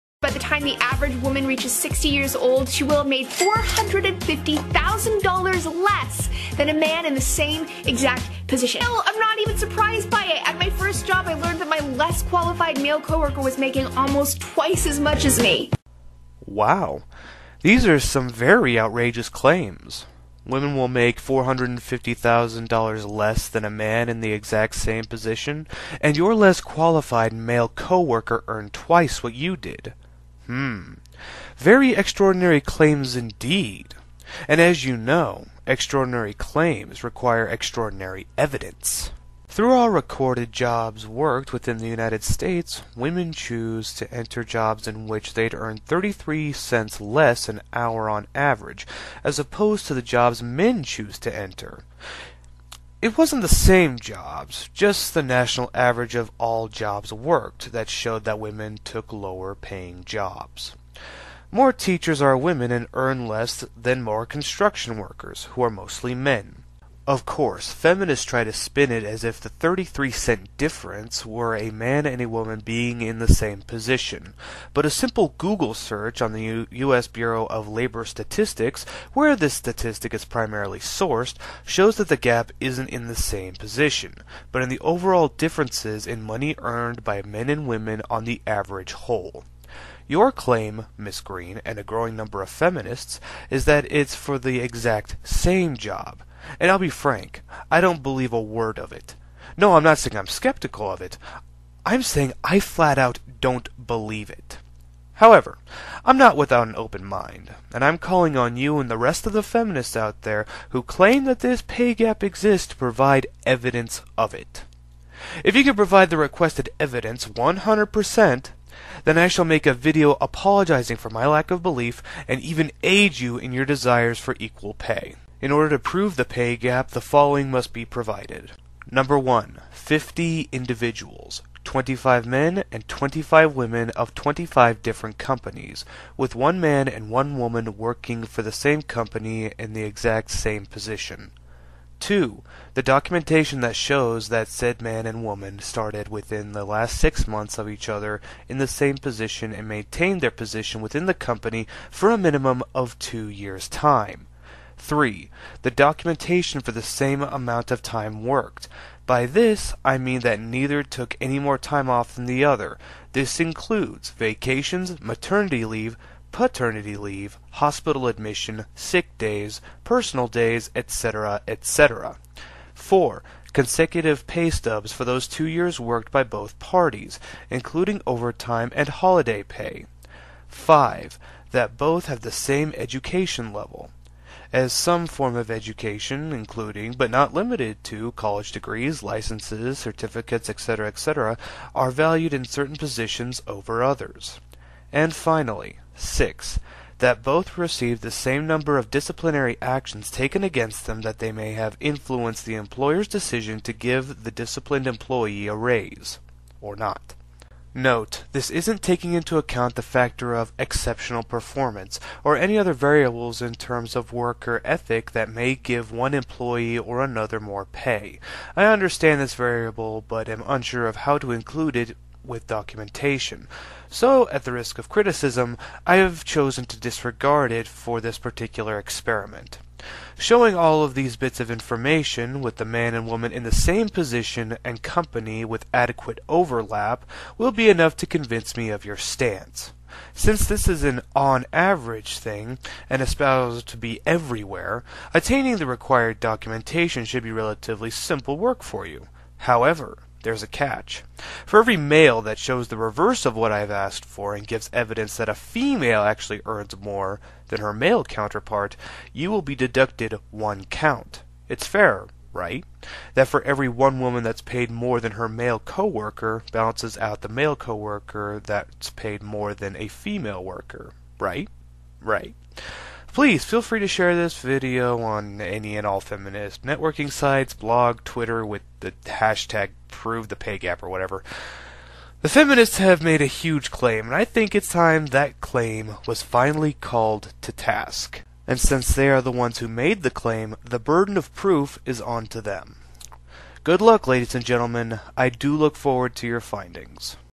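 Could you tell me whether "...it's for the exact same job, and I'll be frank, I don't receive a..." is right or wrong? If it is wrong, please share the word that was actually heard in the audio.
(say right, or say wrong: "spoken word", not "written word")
wrong: "believe", not "receive".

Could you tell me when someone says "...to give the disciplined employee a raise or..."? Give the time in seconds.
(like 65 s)
203 s.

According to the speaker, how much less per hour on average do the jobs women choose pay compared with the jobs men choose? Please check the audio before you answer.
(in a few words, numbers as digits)
33 cents.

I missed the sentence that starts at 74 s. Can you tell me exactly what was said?
But a simple Google search on the U- U.S.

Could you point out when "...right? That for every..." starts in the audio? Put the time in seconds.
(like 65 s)
262 s.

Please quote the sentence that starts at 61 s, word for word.
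More teachers are women and earn less than more construction workers, who are mostly men.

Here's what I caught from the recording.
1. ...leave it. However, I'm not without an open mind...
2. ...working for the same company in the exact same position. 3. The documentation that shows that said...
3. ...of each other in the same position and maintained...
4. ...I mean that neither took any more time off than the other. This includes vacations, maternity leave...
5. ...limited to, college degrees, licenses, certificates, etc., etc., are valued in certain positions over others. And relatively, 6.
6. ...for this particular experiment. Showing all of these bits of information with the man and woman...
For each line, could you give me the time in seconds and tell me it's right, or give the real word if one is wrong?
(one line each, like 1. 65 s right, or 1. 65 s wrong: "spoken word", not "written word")
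1. 103 s wrong: "believe", not "leave"
2. 137 s wrong: "2", not "3"
3. 147 s right
4. 159 s right
5. 187 s wrong: "finally", not "relatively"
6. 227 s right.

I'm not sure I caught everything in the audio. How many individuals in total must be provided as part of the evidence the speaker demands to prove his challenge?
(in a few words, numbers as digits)
50.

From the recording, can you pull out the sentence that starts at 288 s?
And since they are the ones who made the claim, the burden of proof is on to them.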